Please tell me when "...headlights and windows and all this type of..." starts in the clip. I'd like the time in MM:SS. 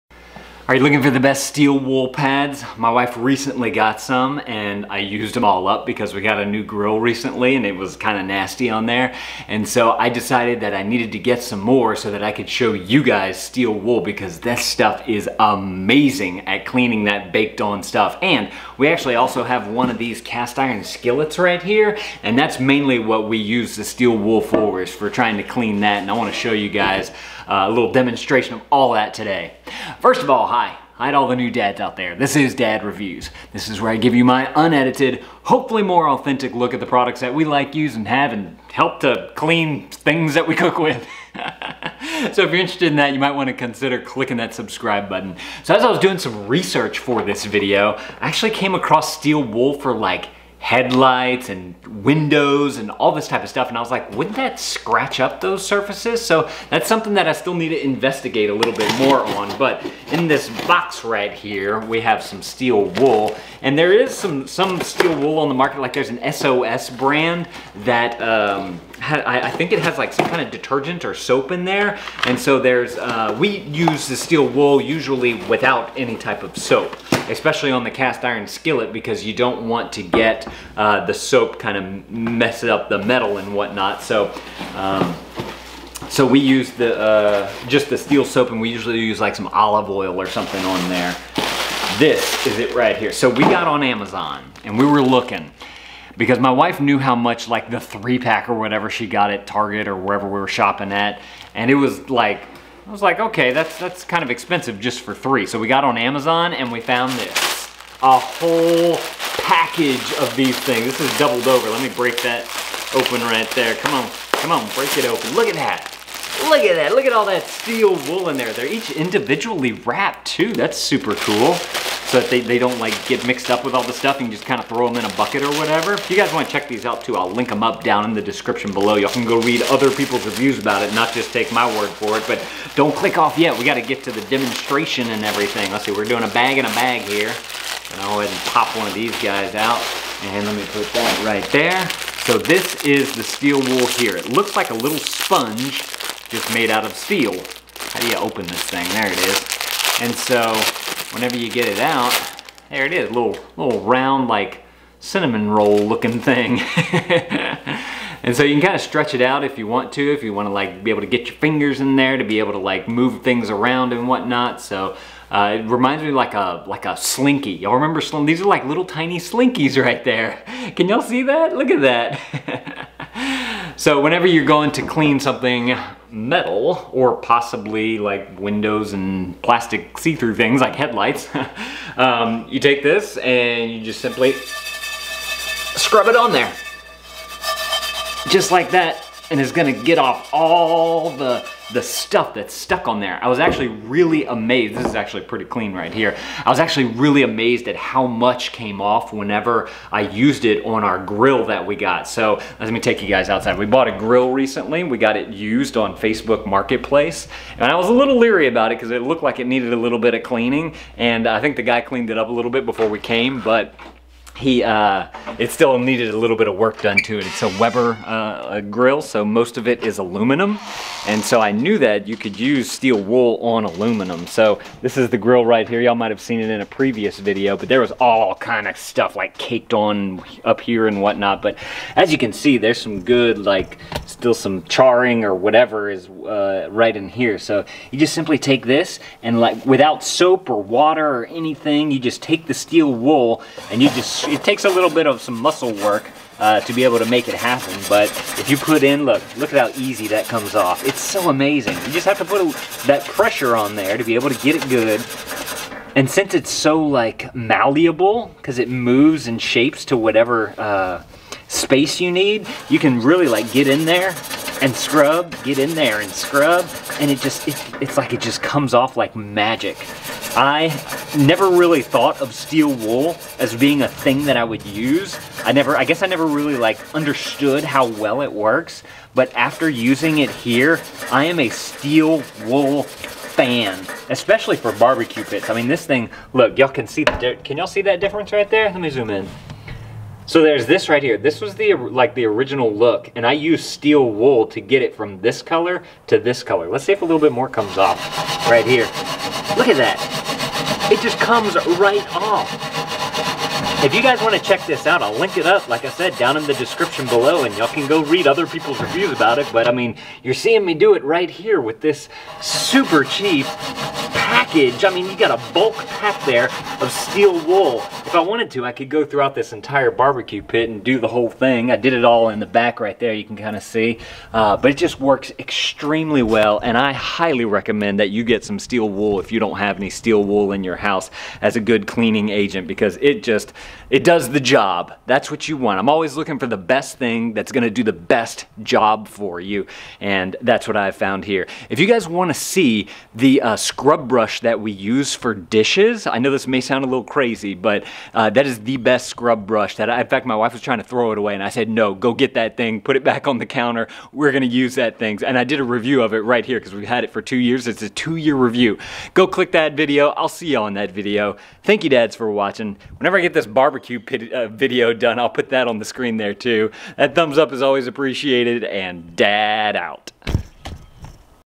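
00:50.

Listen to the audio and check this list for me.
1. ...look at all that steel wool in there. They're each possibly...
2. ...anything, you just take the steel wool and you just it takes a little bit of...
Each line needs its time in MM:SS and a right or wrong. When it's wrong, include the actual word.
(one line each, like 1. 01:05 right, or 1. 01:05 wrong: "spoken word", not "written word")
1. 01:56 wrong: "individually", not "possibly"
2. 04:01 right.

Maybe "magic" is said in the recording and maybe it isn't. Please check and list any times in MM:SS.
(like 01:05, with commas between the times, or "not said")
04:29.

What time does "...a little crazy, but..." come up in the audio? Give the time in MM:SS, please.
05:46.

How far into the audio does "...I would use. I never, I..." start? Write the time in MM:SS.
04:34.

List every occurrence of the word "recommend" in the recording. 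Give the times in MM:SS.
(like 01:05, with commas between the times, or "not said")
05:27.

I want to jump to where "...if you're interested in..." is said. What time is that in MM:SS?
00:42.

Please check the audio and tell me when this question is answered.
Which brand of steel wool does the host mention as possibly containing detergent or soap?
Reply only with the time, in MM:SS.
01:06.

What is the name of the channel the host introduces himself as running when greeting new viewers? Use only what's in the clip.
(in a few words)
Dad Reviews.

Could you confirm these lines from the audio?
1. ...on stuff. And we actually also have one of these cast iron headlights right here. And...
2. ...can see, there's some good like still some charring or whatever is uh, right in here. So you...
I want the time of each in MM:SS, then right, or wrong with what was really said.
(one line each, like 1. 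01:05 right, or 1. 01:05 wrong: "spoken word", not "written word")
1. 00:17 wrong: "skillets", not "headlights"
2. 03:52 right.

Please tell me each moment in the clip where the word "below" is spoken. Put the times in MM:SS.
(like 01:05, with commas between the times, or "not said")
02:08, 05:07.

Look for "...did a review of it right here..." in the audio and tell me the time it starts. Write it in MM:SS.
05:55.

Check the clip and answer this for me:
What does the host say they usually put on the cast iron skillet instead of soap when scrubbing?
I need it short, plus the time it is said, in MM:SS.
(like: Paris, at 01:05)
olive oil, at 01:29.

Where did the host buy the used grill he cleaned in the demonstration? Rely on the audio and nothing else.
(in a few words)
Facebook Marketplace.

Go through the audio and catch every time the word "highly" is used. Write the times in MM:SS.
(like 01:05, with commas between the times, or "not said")
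05:26.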